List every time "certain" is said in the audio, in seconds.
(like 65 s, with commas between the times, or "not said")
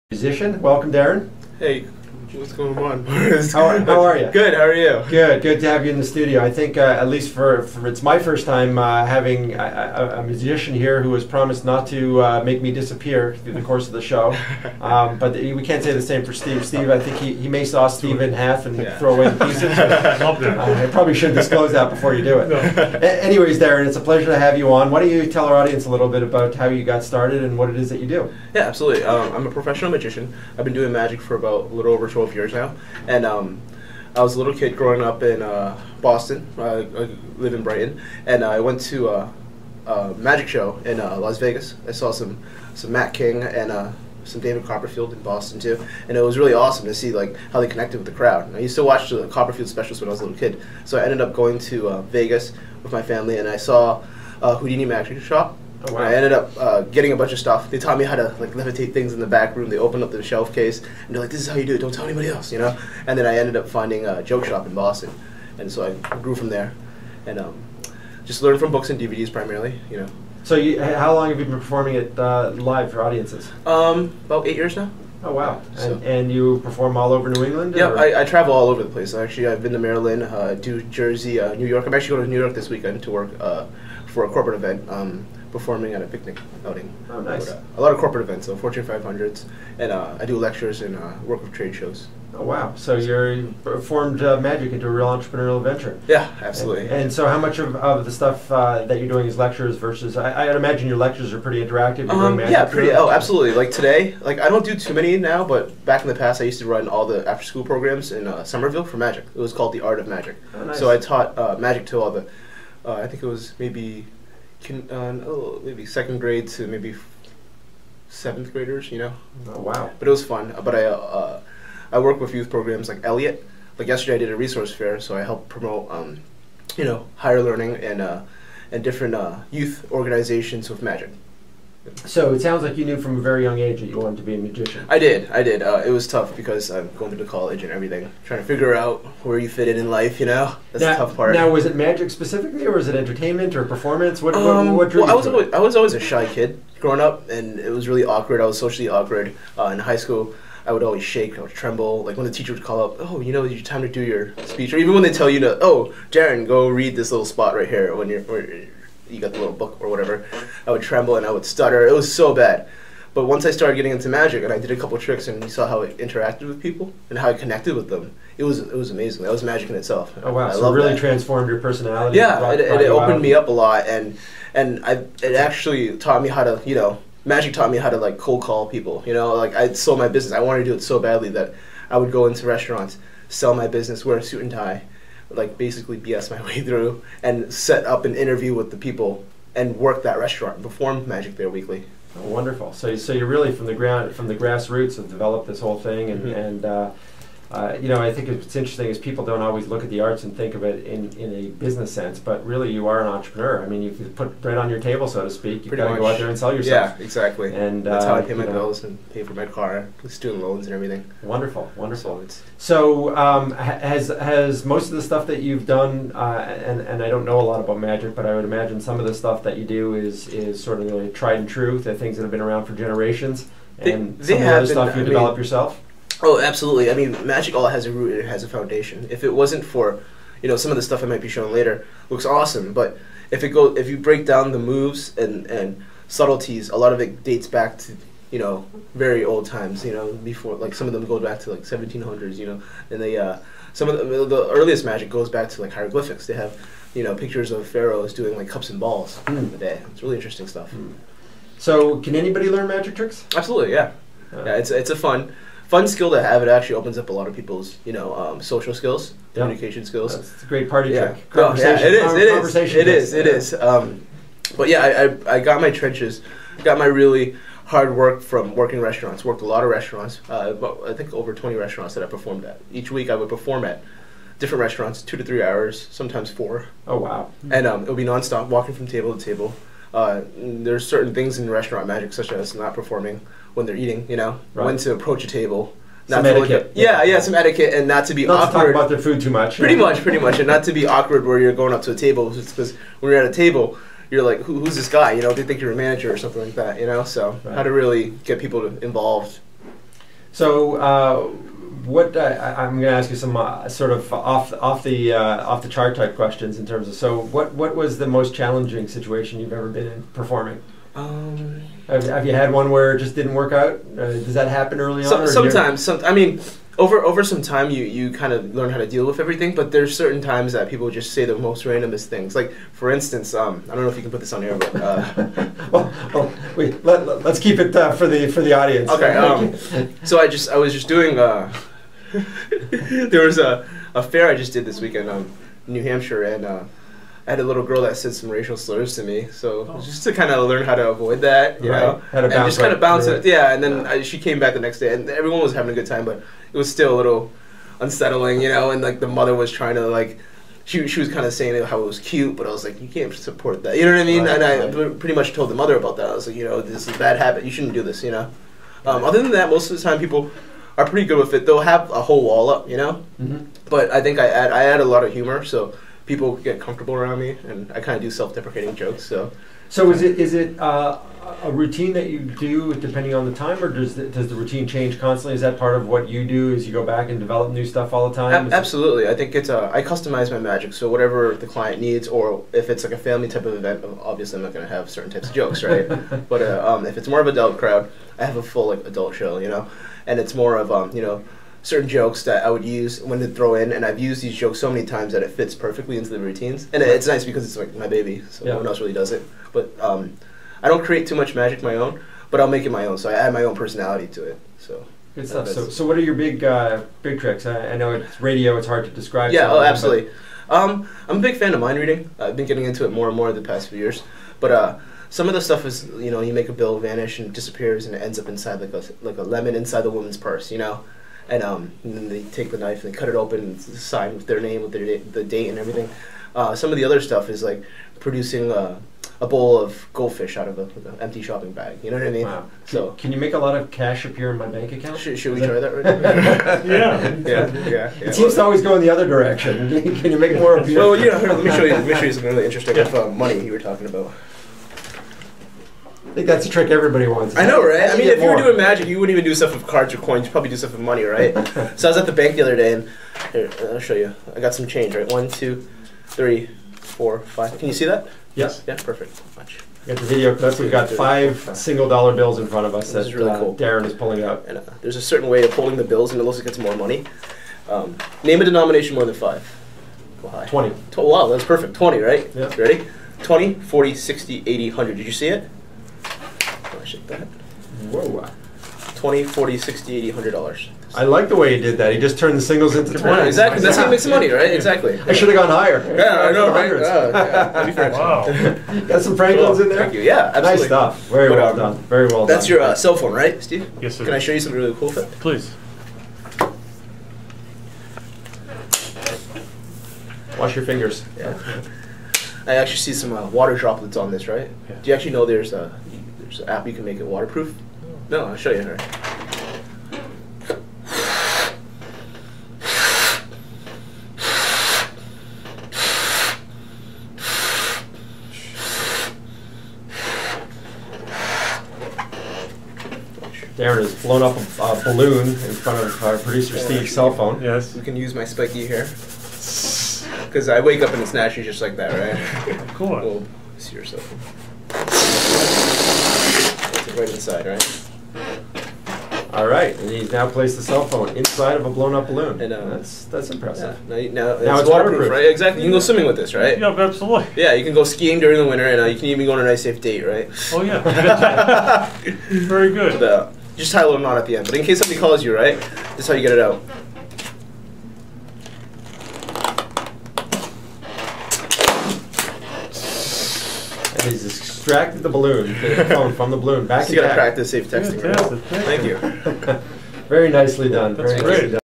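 280 s, 319 s, 384 s, 391 s, 465 s.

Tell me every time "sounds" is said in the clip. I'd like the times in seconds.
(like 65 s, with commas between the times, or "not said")
132 s.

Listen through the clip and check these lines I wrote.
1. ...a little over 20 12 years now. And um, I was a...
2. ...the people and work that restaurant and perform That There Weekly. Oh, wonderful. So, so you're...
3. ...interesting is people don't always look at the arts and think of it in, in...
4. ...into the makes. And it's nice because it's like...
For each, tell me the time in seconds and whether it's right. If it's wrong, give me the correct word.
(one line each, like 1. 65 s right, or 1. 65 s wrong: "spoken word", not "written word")
1. 31 s right
2. 188 s wrong: "Magic", not "That"
3. 198 s right
4. 395 s wrong: "routines", not "makes".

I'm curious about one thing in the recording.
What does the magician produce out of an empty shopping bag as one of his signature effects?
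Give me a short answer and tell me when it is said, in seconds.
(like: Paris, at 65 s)
a bowl of goldfish, at 429 s.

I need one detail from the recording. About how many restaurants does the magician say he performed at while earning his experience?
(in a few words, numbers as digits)
over 20.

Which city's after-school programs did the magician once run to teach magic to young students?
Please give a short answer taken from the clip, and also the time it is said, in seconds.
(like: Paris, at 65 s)
Somerville, at 108 s.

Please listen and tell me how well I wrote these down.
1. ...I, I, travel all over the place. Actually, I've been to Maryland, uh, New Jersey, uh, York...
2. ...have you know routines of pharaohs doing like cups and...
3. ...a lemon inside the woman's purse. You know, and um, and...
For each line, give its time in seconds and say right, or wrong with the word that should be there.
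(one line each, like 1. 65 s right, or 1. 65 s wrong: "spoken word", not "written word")
1. 77 s wrong: "New", not "York"
2. 246 s wrong: "pictures", not "routines"
3. 419 s right.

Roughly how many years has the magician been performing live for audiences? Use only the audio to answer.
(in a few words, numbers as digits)
8.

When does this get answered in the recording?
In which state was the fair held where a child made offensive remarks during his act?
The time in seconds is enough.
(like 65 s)
335 s.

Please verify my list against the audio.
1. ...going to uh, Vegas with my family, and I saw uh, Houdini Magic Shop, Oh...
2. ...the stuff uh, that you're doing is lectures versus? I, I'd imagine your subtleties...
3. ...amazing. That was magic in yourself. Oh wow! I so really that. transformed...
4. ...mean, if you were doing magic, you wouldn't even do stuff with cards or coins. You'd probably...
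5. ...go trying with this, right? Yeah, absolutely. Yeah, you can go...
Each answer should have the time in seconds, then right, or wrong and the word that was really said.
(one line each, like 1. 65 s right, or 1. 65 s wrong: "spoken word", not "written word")
1. 51 s right
2. 98 s wrong: "lectures", not "subtleties"
3. 168 s wrong: "itself", not "yourself"
4. 447 s right
5. 545 s wrong: "swimming", not "trying".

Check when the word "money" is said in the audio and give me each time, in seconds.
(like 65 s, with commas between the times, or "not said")
443 s, 450 s, 466 s, 484 s.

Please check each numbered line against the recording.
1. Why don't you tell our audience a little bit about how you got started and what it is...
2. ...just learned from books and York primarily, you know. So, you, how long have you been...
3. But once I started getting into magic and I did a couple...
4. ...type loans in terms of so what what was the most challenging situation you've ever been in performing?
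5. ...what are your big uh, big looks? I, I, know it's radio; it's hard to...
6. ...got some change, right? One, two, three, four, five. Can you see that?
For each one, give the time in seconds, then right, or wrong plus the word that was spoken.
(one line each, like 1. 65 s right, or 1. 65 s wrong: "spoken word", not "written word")
1. 24 s right
2. 68 s wrong: "DVDs", not "York"
3. 163 s right
4. 305 s wrong: "questions", not "loans"
5. 405 s wrong: "tricks", not "looks"
6. 454 s right.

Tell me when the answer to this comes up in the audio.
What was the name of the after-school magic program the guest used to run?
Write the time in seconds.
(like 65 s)
109 s.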